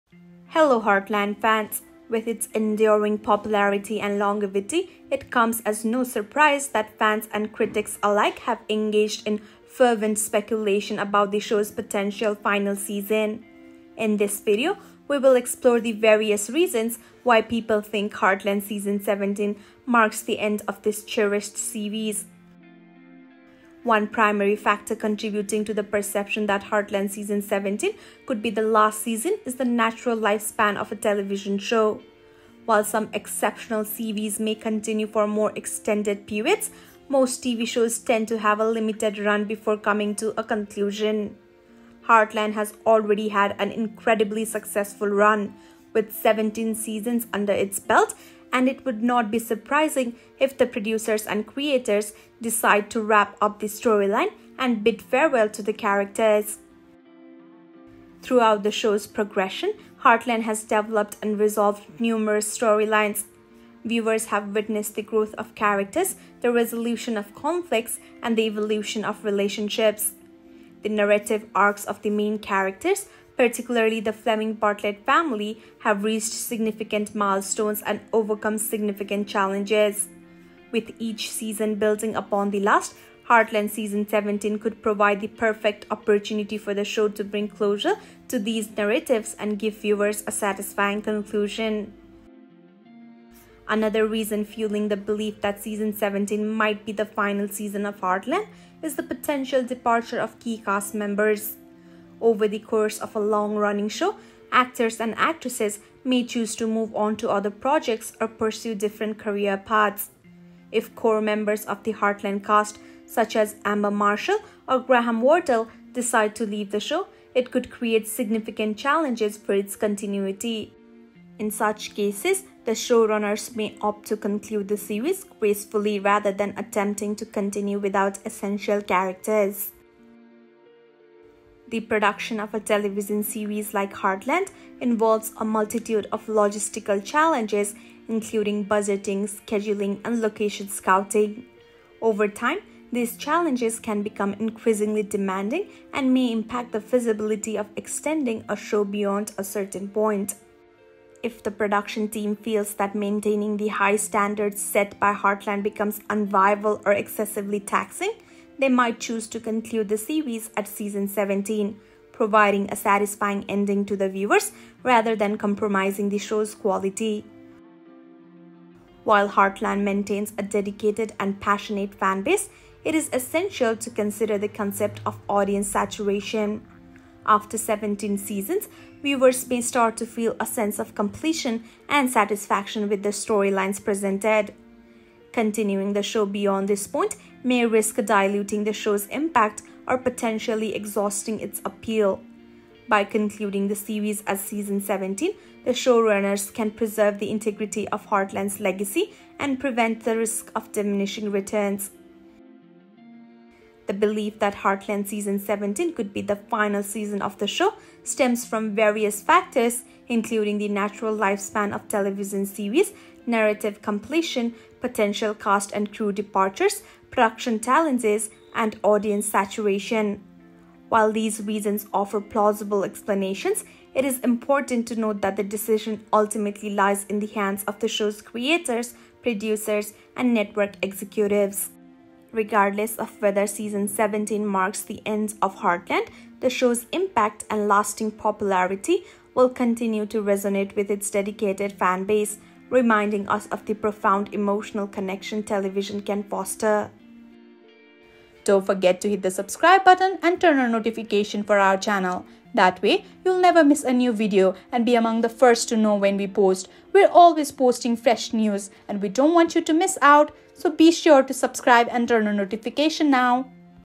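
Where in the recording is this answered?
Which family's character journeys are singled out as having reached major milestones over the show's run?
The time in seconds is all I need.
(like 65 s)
74 s.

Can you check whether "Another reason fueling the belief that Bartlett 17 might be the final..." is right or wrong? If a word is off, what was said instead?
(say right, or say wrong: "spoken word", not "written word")
wrong: "Season", not "Bartlett".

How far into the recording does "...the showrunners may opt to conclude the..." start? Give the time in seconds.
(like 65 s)
122 s.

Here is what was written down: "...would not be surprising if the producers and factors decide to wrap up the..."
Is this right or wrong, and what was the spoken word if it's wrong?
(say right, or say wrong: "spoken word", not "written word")
wrong: "creators", not "factors".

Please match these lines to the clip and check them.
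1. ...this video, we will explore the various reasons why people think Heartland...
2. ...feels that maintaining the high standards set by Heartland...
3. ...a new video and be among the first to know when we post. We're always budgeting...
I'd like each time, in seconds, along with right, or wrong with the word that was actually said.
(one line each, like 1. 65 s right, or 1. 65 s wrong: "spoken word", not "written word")
1. 14 s right
2. 152 s right
3. 253 s wrong: "posting", not "budgeting".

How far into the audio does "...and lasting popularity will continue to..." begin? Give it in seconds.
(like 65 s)
237 s.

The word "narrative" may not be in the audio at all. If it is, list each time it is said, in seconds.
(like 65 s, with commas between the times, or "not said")
70 s, 88 s, 213 s.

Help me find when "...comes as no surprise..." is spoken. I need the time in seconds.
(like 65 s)
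5 s.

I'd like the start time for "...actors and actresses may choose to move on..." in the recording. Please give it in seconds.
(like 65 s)
104 s.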